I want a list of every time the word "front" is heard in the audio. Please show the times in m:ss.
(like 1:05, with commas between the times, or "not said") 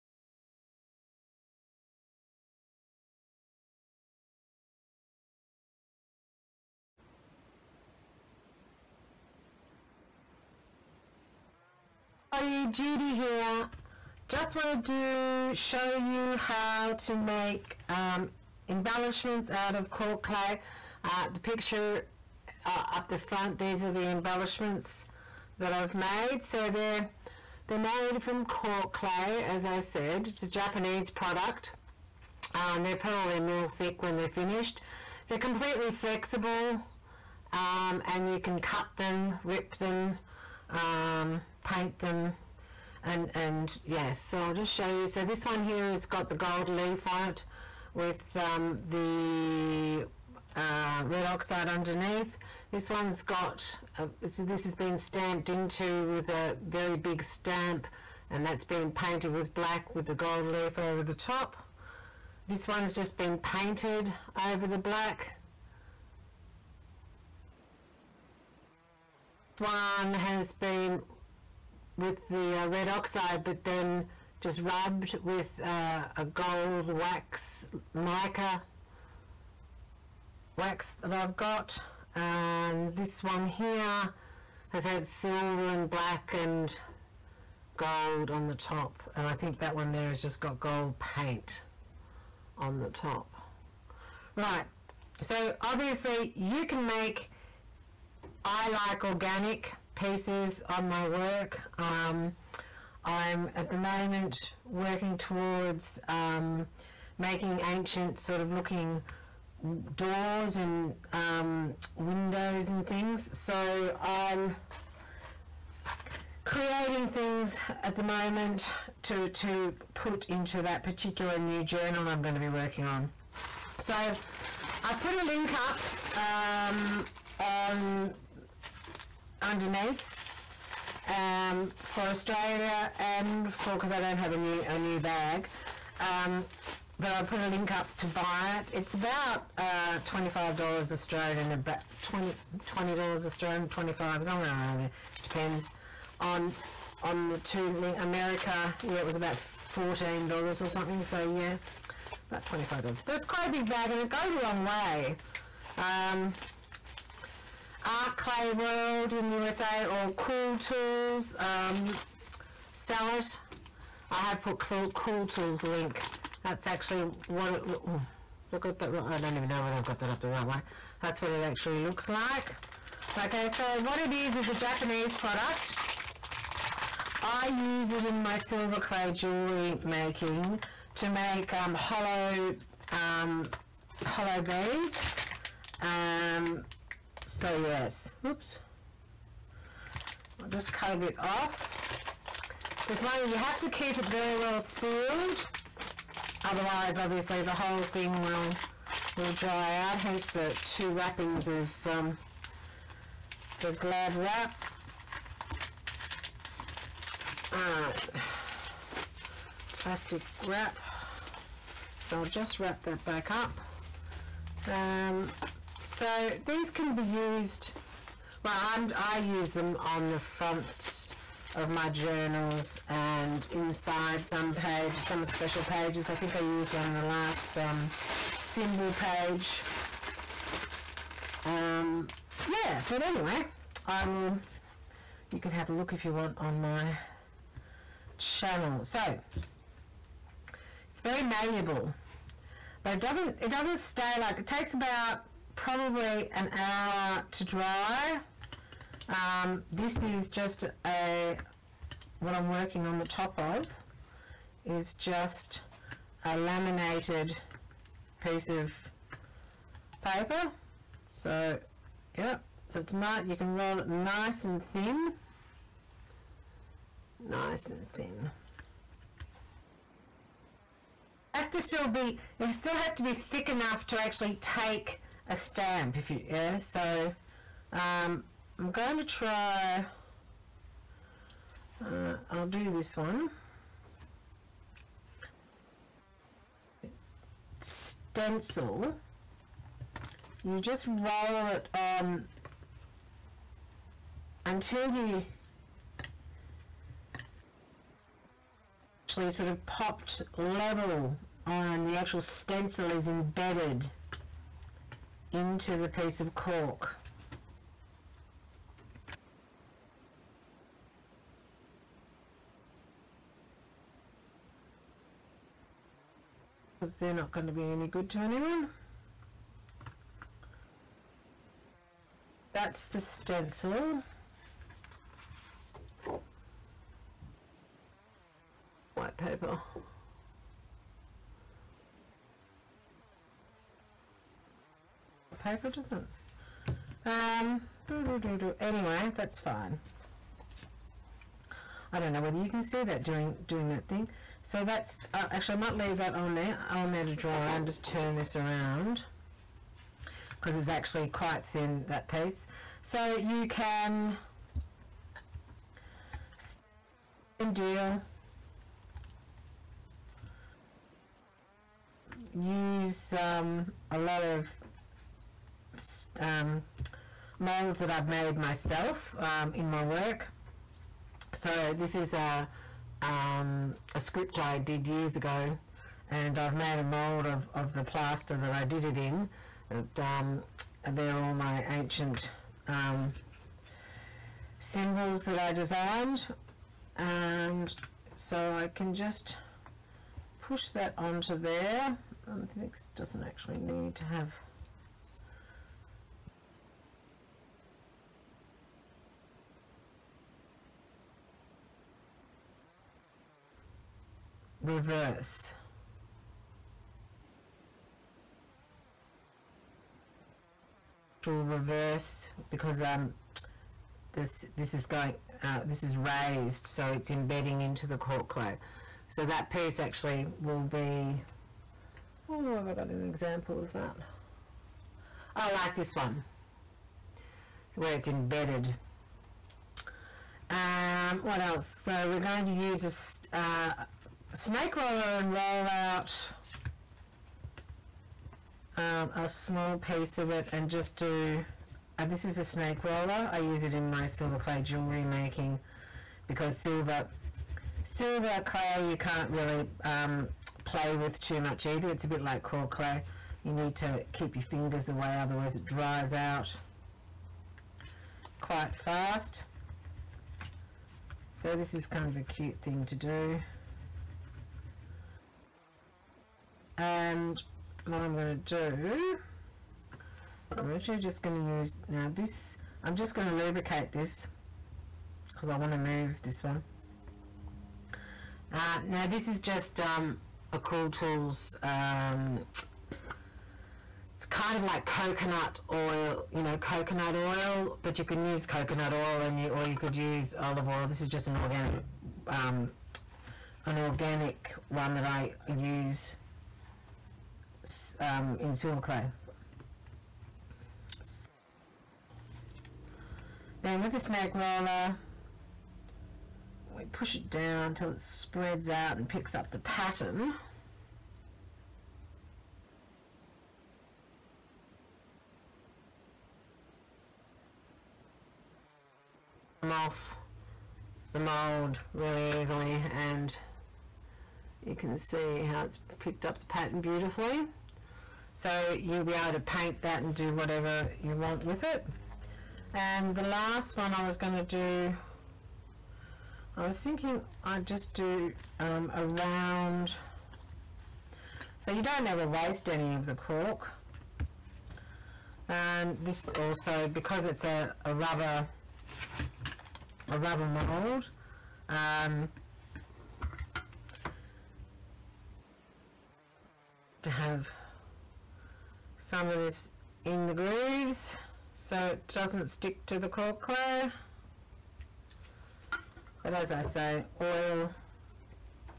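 0:23, 3:40.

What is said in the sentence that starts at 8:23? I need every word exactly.
Then with the snake roller, we push it down until it spreads out and picks up the pattern.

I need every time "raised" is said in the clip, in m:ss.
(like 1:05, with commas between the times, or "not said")
6:55.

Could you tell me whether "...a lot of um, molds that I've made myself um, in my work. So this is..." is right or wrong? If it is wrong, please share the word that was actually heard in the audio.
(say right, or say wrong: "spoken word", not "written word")
right.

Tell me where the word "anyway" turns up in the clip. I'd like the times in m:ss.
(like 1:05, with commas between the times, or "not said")
3:53, 5:38.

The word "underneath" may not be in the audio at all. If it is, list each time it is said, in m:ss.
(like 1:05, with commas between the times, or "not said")
0:51, 2:09.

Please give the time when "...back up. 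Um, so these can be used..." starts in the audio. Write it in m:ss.
3:33.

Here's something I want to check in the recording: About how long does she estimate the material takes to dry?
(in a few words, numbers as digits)
An hour.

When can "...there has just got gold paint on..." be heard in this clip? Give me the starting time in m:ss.
1:29.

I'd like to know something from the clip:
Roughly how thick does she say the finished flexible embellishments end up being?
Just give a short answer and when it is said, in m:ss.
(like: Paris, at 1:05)
A mil, at 0:33.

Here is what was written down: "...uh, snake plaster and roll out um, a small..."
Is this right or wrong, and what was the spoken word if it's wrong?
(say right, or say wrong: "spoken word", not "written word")
wrong: "roller", not "plaster".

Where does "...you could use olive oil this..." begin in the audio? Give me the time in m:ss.
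8:09.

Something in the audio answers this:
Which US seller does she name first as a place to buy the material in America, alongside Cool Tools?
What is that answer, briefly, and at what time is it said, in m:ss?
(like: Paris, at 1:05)
Art Clay World, at 2:37.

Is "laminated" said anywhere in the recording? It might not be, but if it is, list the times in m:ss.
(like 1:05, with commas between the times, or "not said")
4:16.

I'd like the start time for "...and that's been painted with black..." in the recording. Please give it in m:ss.
0:58.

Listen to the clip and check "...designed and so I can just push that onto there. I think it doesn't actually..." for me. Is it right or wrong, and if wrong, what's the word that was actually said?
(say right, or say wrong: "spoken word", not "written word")
right.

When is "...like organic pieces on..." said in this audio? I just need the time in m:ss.
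1:38.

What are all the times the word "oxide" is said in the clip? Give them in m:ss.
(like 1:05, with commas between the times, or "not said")
0:51, 1:12.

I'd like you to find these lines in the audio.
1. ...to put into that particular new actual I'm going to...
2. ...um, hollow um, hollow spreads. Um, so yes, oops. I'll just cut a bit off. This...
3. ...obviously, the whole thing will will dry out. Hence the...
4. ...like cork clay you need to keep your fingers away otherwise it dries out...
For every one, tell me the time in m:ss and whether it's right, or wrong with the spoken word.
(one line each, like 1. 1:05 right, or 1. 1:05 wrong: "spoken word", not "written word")
1. 1:59 wrong: "journal", not "actual"
2. 3:01 wrong: "beads", not "spreads"
3. 3:16 right
4. 7:32 right.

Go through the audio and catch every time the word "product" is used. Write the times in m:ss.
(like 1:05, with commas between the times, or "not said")
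0:31, 2:55.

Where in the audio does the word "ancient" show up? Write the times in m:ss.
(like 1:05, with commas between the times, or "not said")
1:47, 6:21.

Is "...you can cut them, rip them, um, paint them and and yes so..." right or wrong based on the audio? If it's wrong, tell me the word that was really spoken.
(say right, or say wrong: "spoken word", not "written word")
right.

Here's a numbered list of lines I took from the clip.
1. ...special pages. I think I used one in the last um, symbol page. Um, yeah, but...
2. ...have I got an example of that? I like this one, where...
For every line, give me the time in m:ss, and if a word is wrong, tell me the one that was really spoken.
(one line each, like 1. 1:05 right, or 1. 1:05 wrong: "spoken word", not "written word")
1. 3:45 right
2. 7:02 right.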